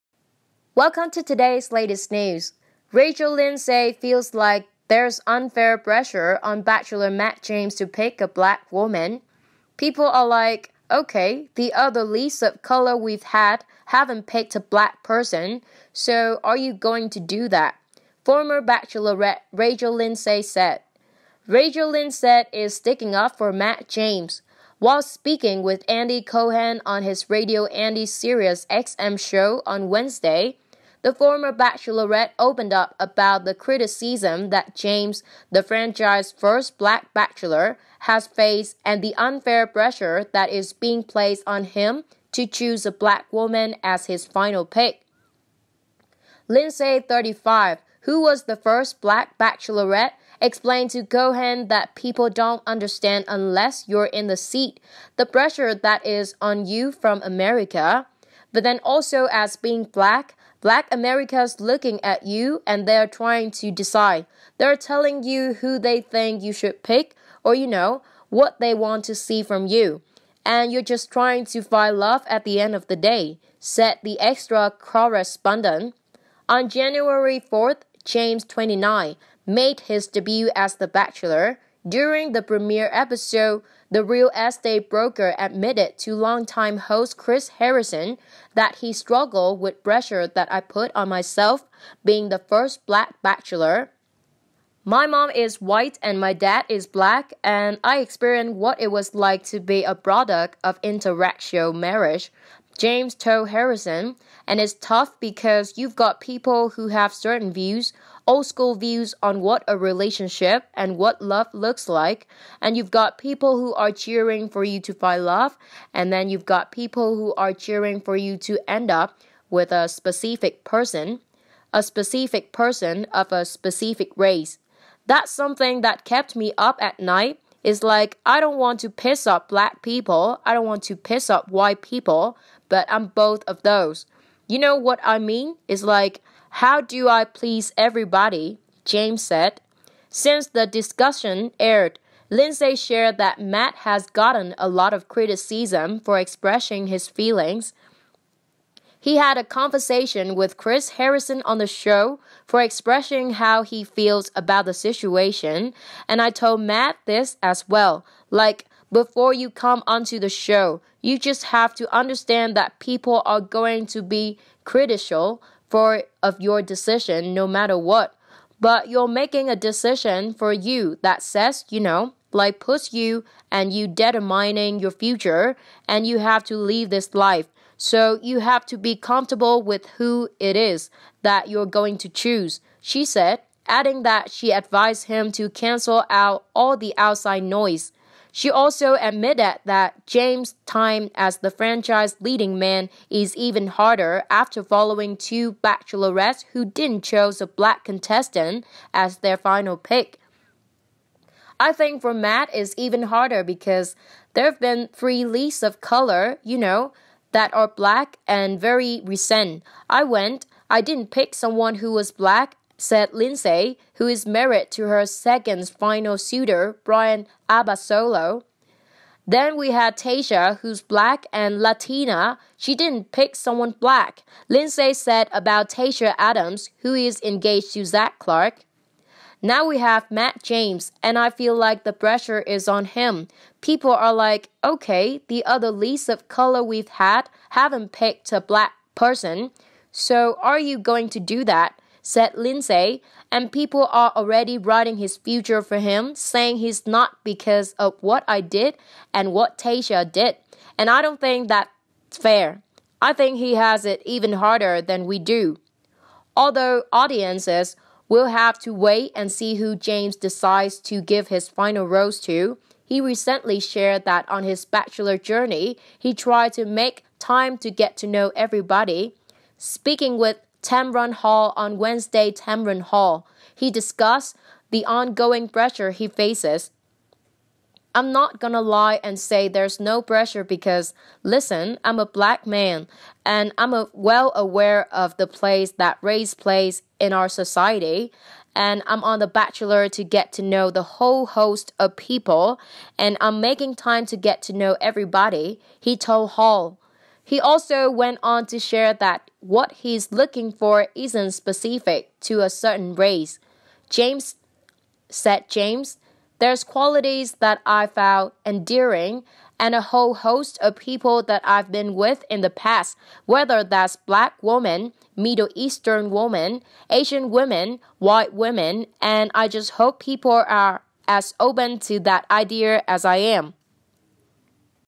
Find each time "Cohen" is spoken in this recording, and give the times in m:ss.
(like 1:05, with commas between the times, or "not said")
0:26, 0:51.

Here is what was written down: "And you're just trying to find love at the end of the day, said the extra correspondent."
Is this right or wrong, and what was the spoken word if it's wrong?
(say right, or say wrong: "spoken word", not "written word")
right.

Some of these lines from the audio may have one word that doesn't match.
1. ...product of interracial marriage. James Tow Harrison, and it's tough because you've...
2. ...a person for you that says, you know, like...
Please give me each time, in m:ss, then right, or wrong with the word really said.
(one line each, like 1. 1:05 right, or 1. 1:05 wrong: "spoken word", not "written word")
1. 1:39 right
2. 2:49 wrong: "decision", not "person".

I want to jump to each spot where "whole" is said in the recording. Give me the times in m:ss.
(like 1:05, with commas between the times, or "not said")
4:50, 5:09.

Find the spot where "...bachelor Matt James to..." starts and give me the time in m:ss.
0:06.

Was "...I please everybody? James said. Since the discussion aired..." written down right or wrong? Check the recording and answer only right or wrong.
right.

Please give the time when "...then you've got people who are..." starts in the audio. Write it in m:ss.
1:56.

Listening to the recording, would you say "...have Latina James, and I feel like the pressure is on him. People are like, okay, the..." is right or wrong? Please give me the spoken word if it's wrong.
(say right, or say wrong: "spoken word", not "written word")
wrong: "Matt", not "Latina".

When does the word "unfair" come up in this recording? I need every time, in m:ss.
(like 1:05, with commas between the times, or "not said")
0:05, 0:39.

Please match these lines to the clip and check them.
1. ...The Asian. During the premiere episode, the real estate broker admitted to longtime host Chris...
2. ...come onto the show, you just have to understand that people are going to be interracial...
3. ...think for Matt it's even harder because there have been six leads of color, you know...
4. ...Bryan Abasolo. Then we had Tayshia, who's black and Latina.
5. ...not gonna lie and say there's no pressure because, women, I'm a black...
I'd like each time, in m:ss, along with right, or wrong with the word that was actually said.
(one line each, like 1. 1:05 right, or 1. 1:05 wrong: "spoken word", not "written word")
1. 1:20 wrong: "Bachelor", not "Asian"
2. 2:39 wrong: "critical", not "interracial"
3. 3:21 wrong: "three", not "six"
4. 3:36 right
5. 4:38 wrong: "listen", not "women".